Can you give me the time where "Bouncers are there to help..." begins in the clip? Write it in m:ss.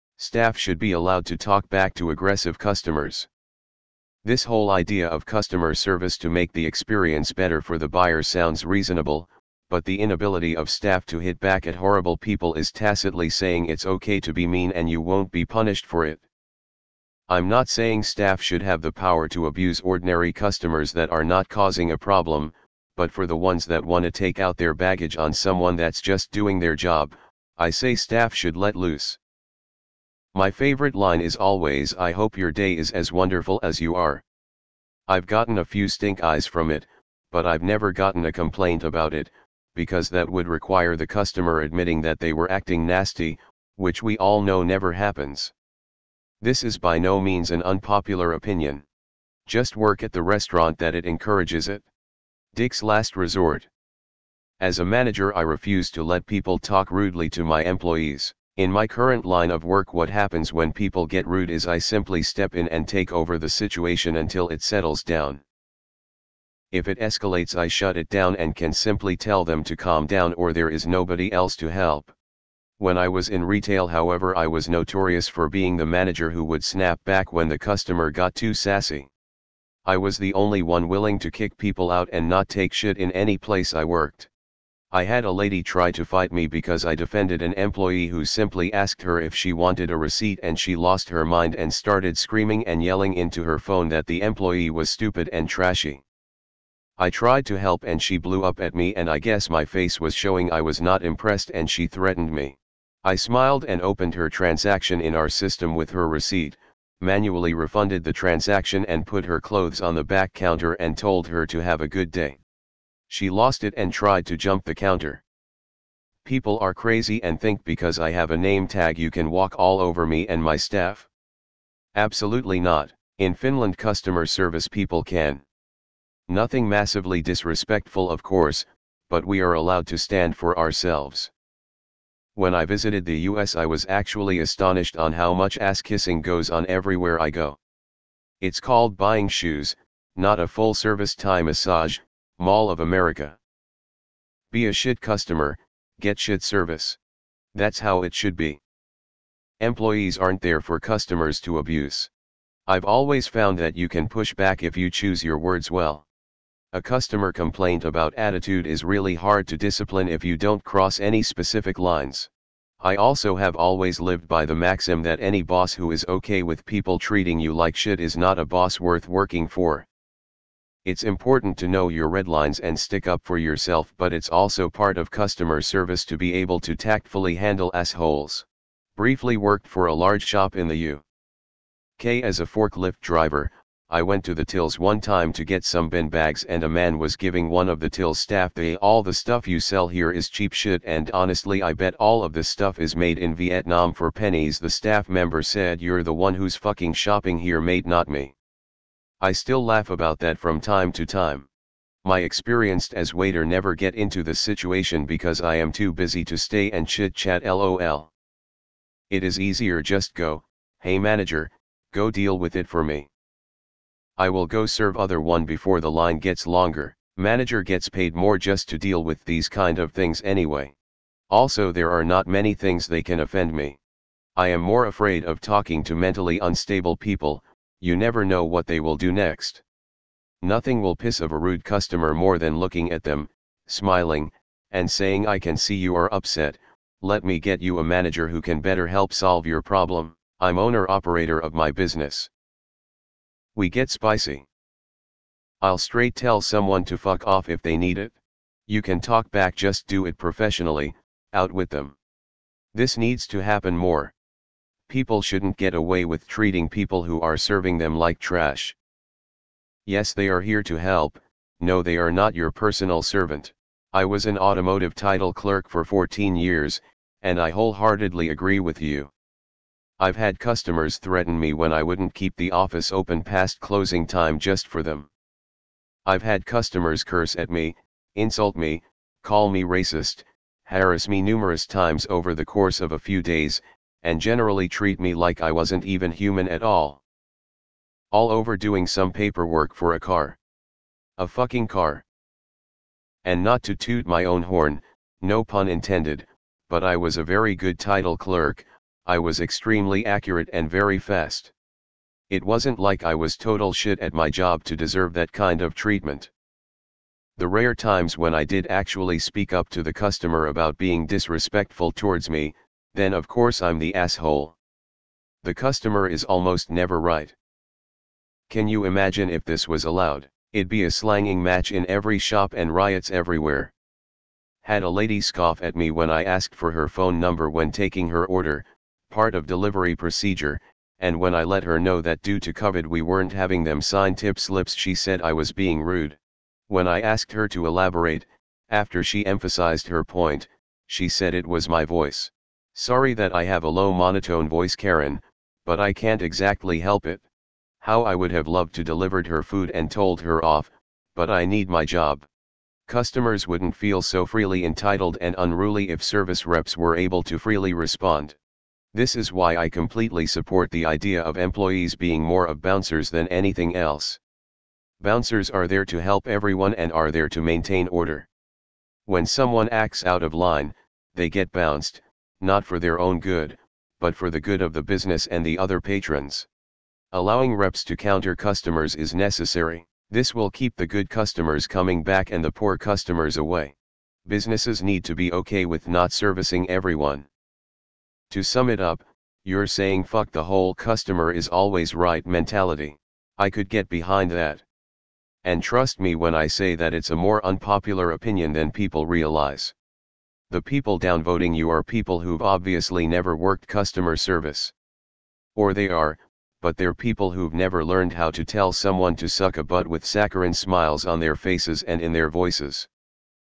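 6:05.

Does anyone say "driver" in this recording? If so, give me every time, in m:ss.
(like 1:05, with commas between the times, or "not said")
3:02.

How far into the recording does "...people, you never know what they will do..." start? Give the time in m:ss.
3:46.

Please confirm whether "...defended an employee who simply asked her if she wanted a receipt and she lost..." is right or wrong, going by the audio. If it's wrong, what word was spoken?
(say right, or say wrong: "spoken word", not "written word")
right.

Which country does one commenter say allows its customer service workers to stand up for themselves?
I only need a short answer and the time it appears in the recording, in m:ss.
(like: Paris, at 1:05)
Finland, at 2:03.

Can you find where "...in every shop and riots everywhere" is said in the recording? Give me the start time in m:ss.
5:21.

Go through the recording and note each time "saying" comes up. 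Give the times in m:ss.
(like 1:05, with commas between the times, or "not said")
0:13, 0:17, 3:54, 6:29.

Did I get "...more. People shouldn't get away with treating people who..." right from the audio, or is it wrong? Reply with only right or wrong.
right.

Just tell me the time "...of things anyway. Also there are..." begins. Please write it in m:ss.
3:39.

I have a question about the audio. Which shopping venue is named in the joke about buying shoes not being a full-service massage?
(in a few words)
Mall of America.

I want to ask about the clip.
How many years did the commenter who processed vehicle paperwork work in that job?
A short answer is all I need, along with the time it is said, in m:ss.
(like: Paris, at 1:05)
14, at 4:25.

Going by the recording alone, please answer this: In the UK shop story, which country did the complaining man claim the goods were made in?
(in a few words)
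Vietnam.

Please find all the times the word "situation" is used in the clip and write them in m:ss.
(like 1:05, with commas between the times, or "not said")
1:03, 3:24.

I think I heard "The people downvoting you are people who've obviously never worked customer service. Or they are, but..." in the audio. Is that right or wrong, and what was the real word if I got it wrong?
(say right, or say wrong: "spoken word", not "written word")
right.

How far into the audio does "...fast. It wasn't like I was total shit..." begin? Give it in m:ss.
5:00.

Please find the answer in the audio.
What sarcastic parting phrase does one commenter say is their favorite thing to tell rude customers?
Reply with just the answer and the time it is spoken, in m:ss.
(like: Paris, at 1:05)
I hope your day is as wonderful as you are, at 0:31.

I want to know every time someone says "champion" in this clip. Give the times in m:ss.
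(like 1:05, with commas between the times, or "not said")
not said.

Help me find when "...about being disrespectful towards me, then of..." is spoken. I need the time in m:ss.
5:10.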